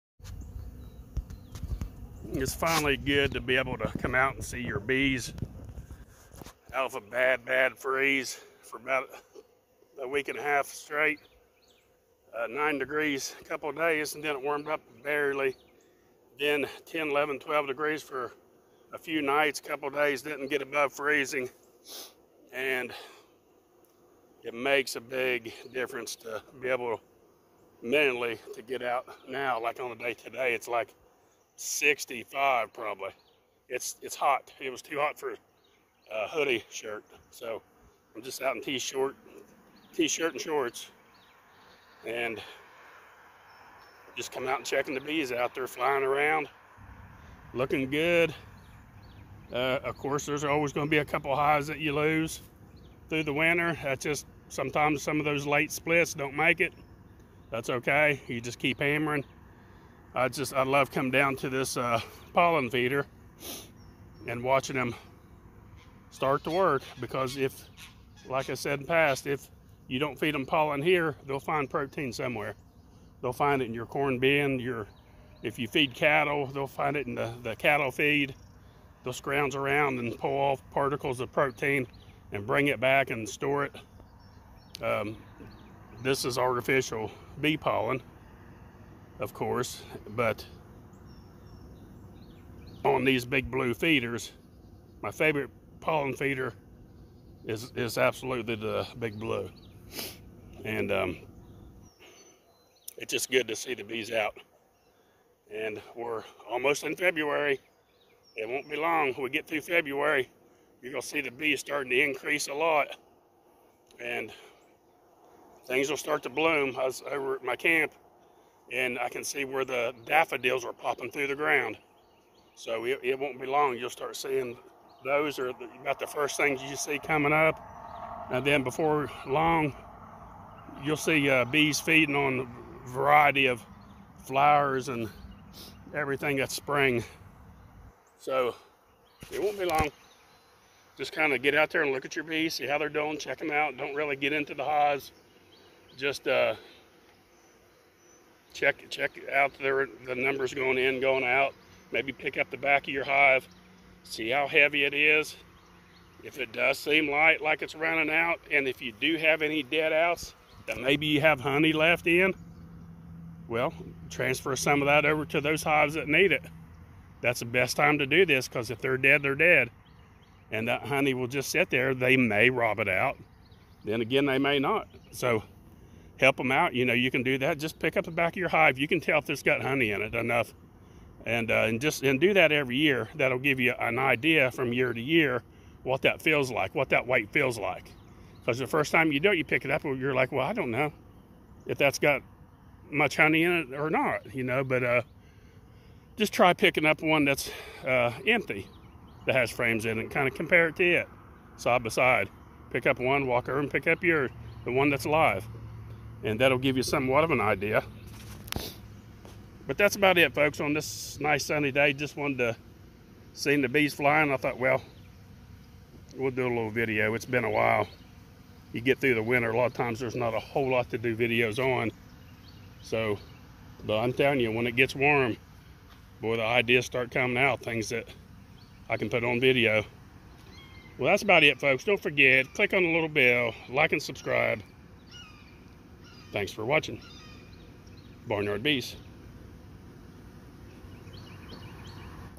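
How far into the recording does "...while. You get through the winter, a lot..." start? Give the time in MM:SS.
03:37.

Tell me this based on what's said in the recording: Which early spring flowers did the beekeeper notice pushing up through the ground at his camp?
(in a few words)
daffodils.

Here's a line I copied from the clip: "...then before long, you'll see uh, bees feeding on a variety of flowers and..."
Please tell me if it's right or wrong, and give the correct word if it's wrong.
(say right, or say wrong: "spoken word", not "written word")
right.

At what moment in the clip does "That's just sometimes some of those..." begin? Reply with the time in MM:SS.
00:53.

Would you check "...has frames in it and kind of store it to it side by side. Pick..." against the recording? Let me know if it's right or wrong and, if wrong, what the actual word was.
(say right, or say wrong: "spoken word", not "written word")
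wrong: "compare", not "store".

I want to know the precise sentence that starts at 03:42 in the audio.
So, but I'm telling you, when it gets warm, boy, the ideas start coming out, things that I can put on video.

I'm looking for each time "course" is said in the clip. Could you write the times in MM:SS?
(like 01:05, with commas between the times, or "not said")
00:49, 01:29.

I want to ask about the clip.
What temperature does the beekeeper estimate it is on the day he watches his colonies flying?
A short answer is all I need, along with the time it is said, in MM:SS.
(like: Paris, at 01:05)
65, at 00:31.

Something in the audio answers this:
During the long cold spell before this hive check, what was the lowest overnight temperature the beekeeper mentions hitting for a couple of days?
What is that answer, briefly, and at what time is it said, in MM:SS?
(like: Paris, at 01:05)
9 degrees, at 00:12.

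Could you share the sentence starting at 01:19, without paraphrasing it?
They'll scrounge around and pull off particles of protein and bring it back and store it.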